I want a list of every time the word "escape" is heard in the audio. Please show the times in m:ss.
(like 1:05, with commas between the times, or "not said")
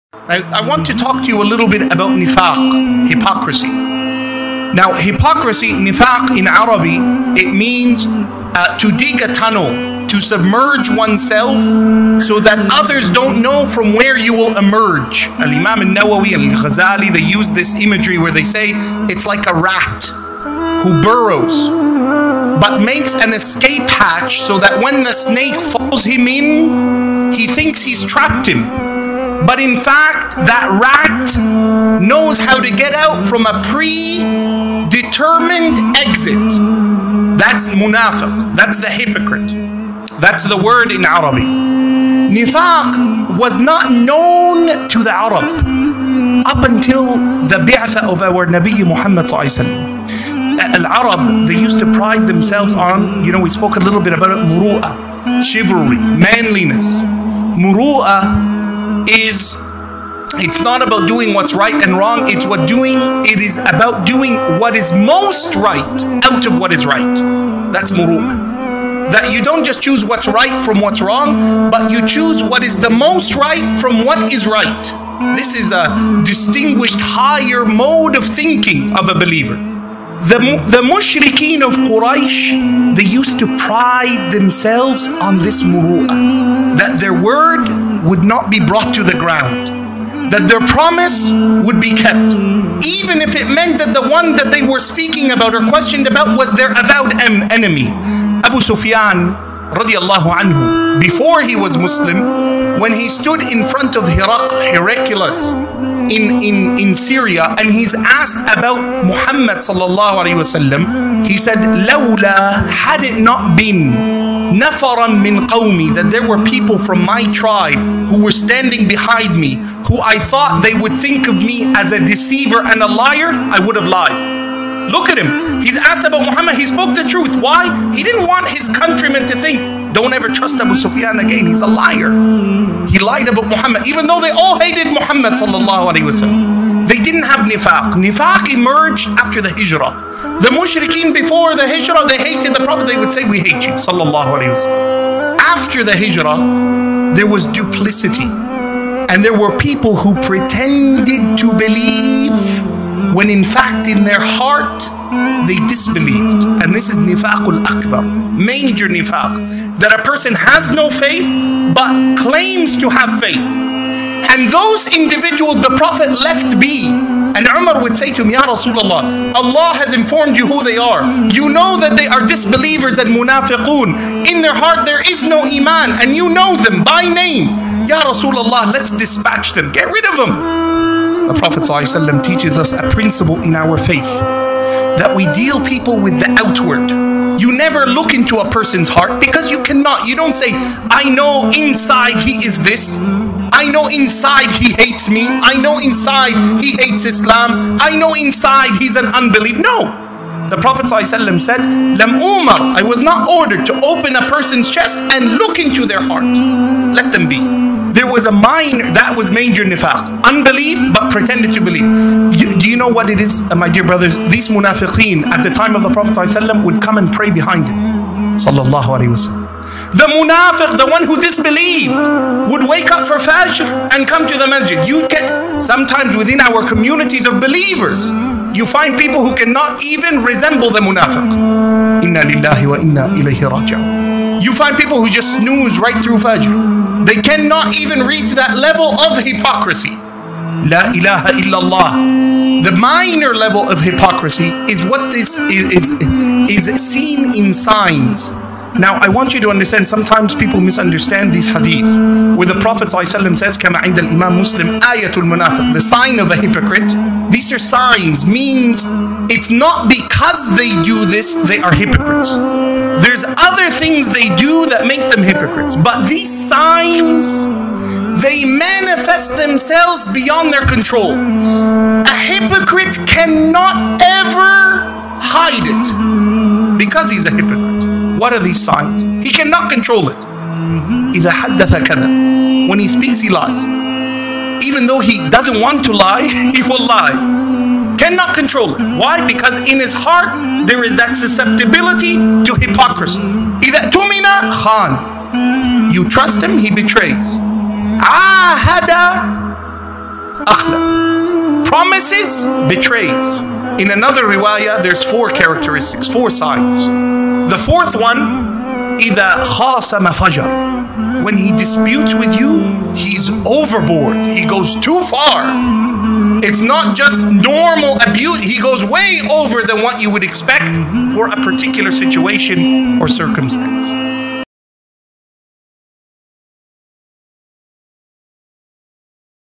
0:23.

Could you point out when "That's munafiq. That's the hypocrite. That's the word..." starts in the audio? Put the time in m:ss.
0:37.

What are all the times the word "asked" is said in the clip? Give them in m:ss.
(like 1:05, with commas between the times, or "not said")
1:47, 2:05.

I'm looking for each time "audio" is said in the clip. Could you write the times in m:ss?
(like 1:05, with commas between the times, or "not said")
not said.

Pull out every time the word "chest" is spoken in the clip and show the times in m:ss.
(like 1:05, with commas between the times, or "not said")
3:24.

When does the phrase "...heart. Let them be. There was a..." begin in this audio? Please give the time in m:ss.
3:26.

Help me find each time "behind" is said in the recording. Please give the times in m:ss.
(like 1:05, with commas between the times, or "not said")
1:58, 3:37.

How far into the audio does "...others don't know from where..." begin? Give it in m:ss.
0:12.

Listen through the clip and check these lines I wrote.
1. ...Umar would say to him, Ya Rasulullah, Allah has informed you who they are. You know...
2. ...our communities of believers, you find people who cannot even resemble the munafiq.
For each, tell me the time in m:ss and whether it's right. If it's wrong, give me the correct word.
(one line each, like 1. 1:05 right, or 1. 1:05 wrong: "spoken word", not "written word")
1. 2:47 right
2. 3:46 right.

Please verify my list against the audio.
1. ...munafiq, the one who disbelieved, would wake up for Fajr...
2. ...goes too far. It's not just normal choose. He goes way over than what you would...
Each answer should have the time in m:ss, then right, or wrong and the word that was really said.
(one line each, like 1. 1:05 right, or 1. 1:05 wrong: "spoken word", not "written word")
1. 3:40 right
2. 5:14 wrong: "abuse", not "choose".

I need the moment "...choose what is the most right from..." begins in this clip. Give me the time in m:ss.
1:12.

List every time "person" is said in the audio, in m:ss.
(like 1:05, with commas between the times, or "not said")
2:40, 3:08, 3:24.